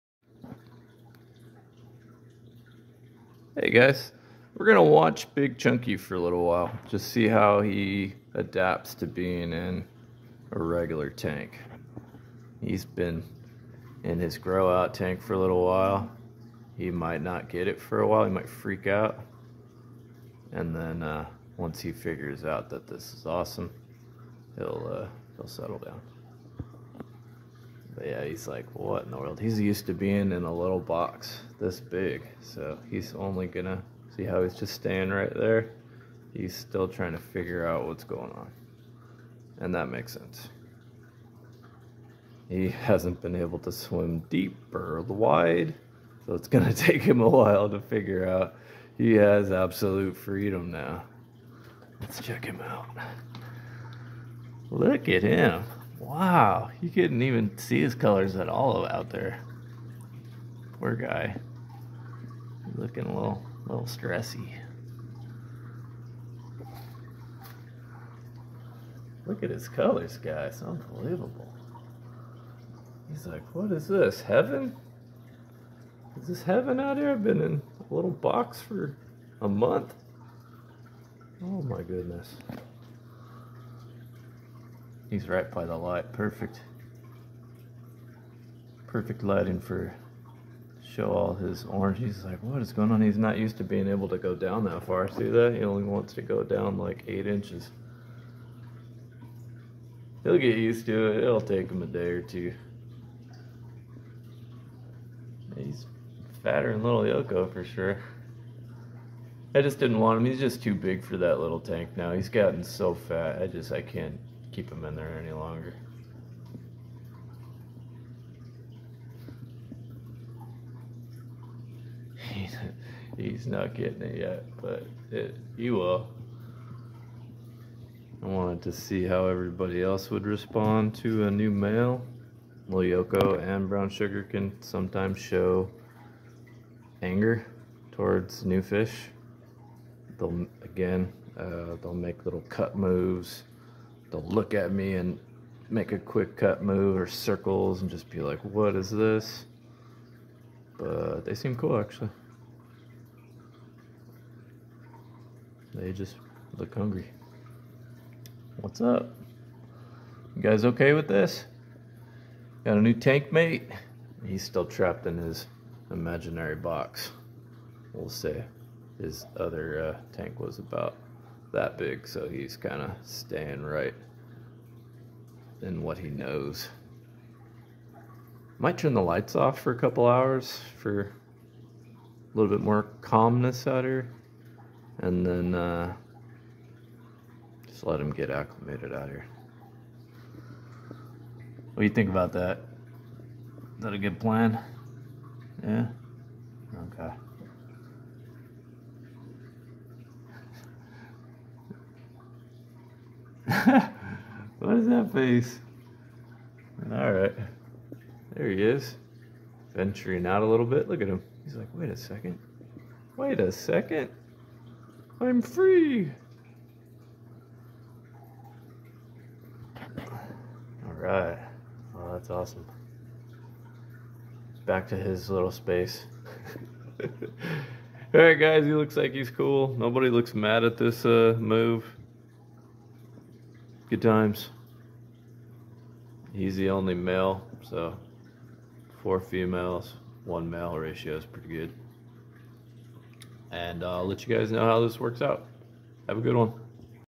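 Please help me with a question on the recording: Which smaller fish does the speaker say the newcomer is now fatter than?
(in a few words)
Yoko.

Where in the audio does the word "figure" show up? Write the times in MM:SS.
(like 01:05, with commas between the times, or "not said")
00:21, 00:37, 00:47.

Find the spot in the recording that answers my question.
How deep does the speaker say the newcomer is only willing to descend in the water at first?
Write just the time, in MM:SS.
01:37.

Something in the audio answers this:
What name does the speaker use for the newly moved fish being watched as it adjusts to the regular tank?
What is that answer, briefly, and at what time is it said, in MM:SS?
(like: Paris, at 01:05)
Big Chunky, at 00:05.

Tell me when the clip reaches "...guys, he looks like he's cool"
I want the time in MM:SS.
03:48.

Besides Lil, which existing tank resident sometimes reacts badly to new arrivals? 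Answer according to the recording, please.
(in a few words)
Brown Sugar.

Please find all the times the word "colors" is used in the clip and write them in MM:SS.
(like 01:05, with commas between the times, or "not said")
00:57, 01:09.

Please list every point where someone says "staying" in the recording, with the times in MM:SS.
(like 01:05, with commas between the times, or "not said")
00:34, 02:53.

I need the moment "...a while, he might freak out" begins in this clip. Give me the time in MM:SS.
00:17.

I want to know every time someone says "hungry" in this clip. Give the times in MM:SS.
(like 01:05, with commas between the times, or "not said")
02:36.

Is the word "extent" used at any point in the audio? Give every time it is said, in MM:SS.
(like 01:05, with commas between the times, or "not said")
not said.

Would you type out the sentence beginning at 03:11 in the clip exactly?
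What do you think about that?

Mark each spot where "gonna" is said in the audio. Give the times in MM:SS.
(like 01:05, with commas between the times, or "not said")
00:04, 00:33, 00:46.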